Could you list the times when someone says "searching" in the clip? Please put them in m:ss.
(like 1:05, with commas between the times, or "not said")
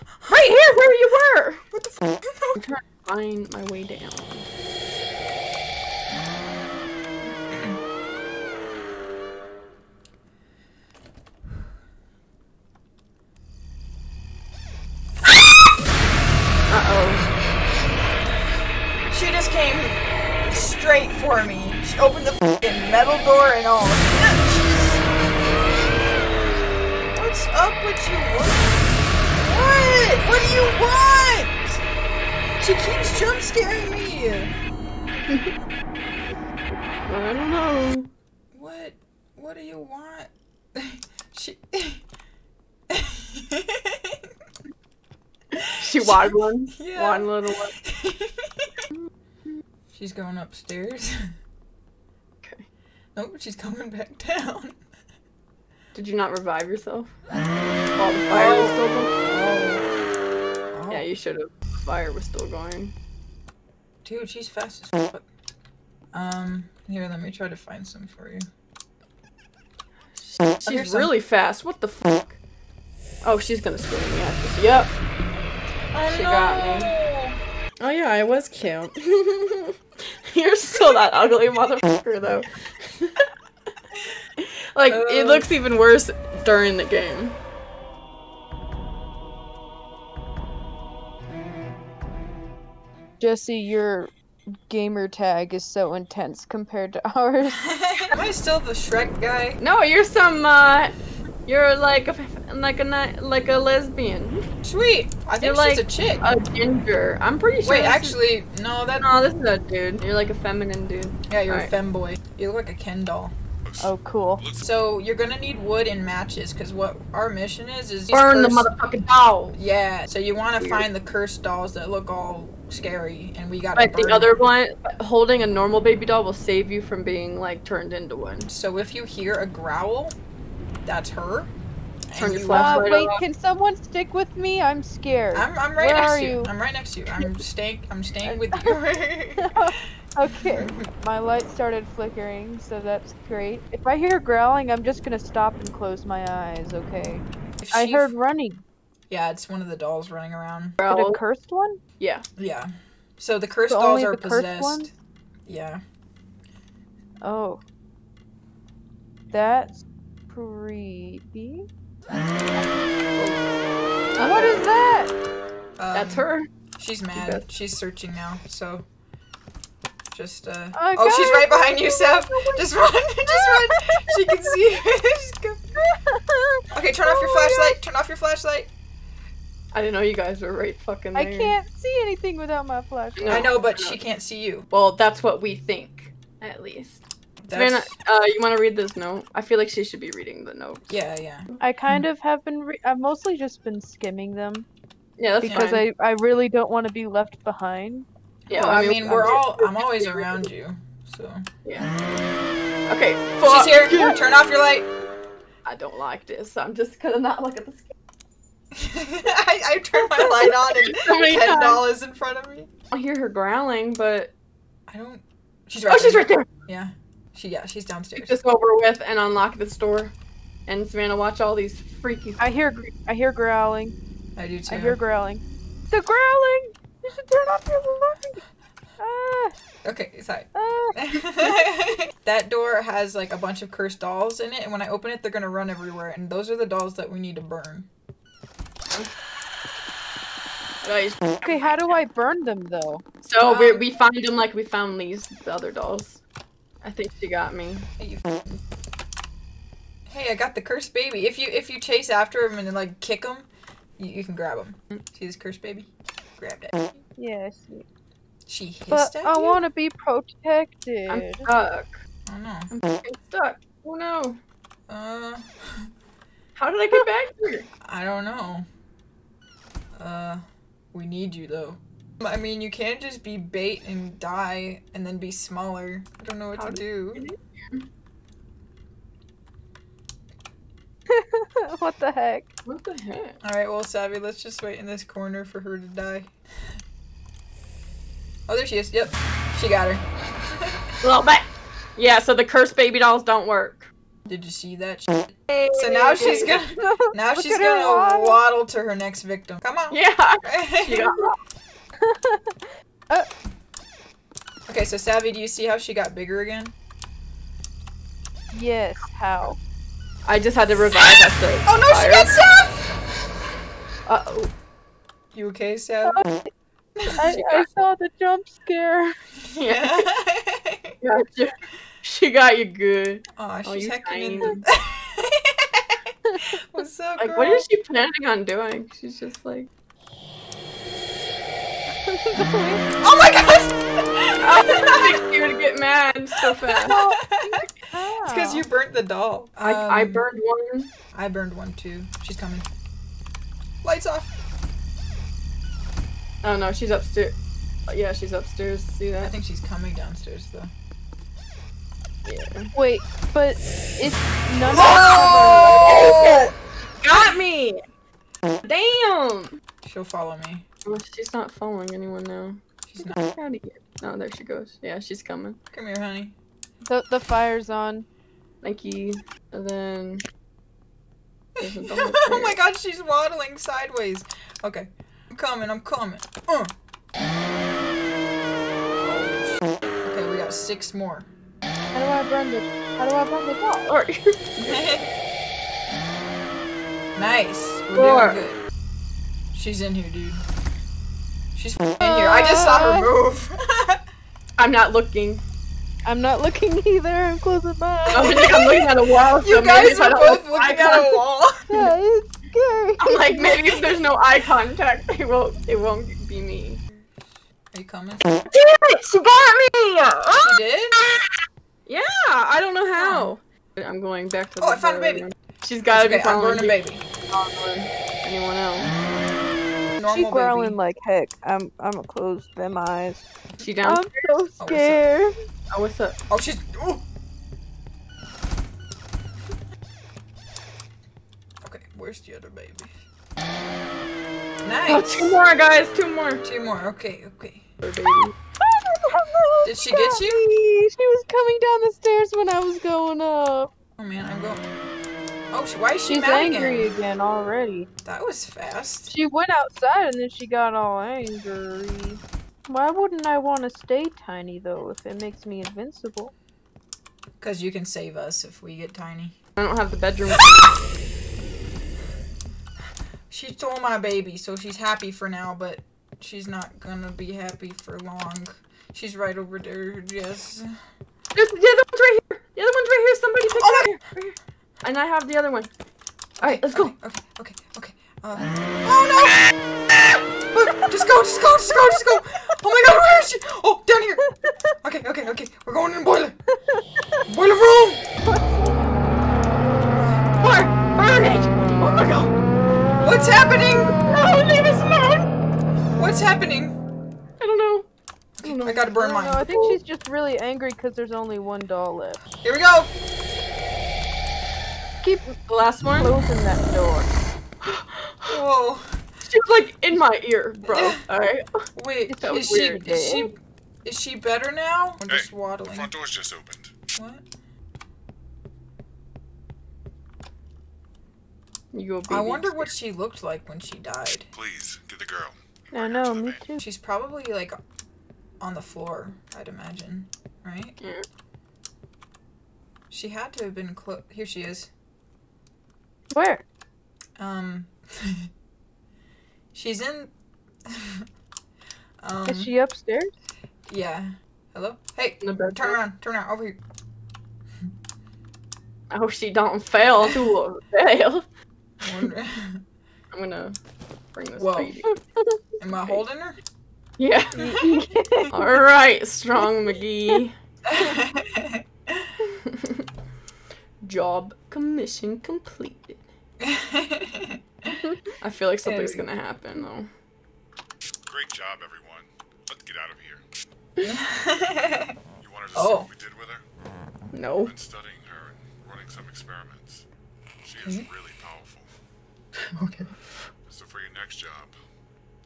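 2:47.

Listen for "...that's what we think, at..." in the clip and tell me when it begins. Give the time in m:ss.
3:04.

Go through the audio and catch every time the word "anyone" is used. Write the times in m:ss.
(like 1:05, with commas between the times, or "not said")
6:01, 6:58.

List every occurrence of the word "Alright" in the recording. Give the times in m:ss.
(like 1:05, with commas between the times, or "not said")
4:43, 7:56, 8:31.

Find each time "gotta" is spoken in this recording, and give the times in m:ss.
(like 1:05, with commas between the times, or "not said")
6:55, 8:18.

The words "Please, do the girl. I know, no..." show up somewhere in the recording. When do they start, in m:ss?
8:44.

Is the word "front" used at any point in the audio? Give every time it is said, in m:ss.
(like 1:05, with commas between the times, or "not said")
3:32, 8:35.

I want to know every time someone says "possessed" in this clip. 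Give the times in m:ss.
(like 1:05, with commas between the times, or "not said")
2:34.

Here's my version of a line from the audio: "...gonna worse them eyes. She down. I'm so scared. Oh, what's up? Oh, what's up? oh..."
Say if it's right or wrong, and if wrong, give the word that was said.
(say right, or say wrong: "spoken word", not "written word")
wrong: "close", not "worse".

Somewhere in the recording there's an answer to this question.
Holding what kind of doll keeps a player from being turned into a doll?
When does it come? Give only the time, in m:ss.
2:05.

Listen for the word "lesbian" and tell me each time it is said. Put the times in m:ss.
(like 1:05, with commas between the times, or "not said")
1:43.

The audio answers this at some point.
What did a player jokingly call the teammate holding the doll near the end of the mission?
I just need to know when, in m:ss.
9:19.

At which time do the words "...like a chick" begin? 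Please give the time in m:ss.
1:45.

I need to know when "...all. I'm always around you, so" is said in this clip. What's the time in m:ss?
3:19.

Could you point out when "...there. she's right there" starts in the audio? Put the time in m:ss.
3:36.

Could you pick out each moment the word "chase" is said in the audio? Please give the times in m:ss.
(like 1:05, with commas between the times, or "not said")
4:11.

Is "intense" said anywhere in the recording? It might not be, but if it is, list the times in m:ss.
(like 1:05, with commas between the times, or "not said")
1:35.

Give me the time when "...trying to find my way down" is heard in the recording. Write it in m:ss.
0:02.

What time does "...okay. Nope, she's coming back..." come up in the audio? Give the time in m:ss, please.
0:52.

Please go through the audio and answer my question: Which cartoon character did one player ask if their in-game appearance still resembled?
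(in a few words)
Shrek.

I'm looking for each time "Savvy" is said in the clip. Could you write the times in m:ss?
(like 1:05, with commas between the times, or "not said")
4:43, 5:04, 5:15.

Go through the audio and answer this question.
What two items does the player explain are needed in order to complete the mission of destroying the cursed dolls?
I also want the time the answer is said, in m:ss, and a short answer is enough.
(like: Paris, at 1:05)
wood and matches, at 1:55.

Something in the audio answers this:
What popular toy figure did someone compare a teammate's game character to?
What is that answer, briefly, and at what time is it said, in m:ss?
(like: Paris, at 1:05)
Ken doll, at 1:52.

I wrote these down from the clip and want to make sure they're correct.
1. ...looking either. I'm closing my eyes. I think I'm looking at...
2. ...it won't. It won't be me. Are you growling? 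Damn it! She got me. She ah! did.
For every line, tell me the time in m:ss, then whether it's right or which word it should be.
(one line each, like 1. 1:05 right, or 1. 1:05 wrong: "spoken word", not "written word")
1. 6:36 right
2. 6:45 wrong: "coming", not "growling".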